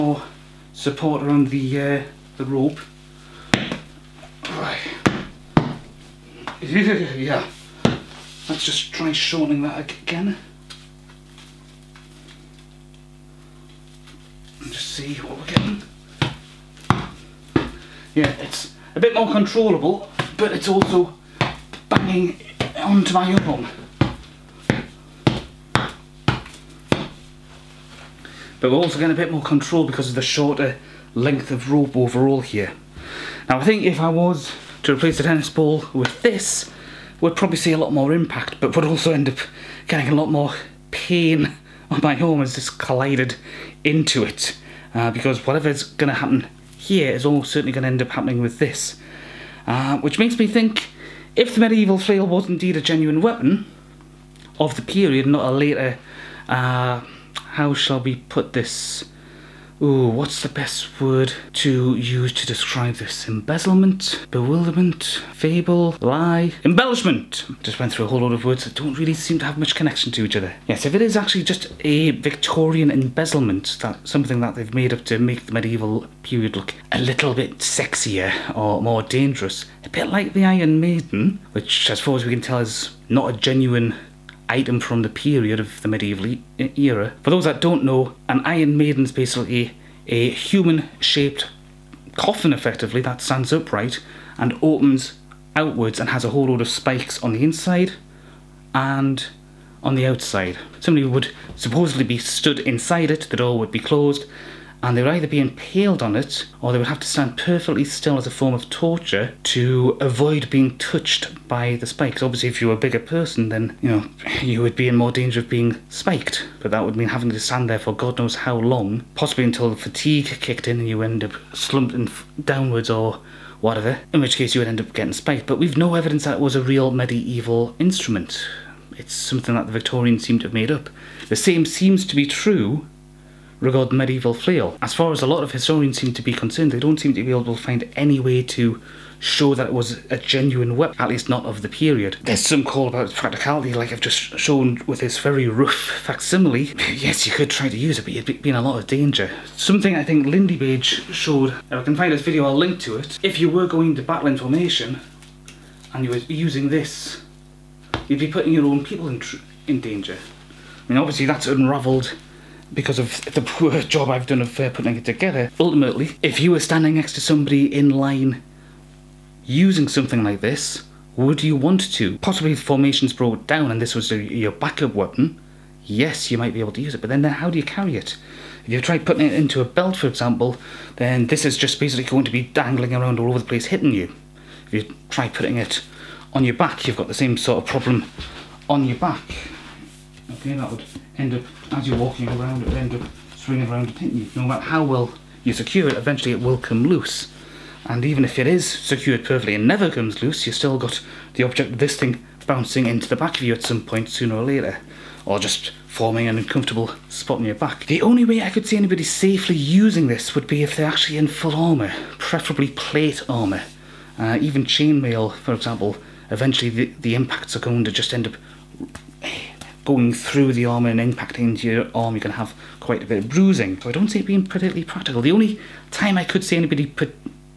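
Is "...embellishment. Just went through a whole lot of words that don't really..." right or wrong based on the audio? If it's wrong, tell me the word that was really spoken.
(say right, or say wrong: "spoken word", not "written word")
right.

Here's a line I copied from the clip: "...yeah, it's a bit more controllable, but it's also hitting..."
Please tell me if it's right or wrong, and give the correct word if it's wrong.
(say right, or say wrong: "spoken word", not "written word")
wrong: "banging", not "hitting".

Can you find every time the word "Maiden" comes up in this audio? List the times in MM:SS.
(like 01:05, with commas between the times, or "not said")
01:20, 01:28.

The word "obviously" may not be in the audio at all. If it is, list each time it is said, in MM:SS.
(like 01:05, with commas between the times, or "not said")
01:52, 02:40.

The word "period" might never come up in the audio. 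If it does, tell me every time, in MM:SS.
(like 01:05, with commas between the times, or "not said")
00:54, 01:16, 01:25, 02:21.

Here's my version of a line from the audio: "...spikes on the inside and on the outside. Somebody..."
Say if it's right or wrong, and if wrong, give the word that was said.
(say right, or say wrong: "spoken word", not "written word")
right.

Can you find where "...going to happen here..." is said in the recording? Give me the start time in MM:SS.
00:45.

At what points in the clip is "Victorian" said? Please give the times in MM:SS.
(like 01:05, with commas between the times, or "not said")
01:12, 02:09.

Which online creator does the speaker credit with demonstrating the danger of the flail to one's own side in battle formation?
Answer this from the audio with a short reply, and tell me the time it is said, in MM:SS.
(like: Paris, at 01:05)
Lindybeige, at 02:30.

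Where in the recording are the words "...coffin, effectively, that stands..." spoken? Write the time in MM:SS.
01:32.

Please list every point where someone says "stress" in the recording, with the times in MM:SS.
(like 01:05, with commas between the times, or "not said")
not said.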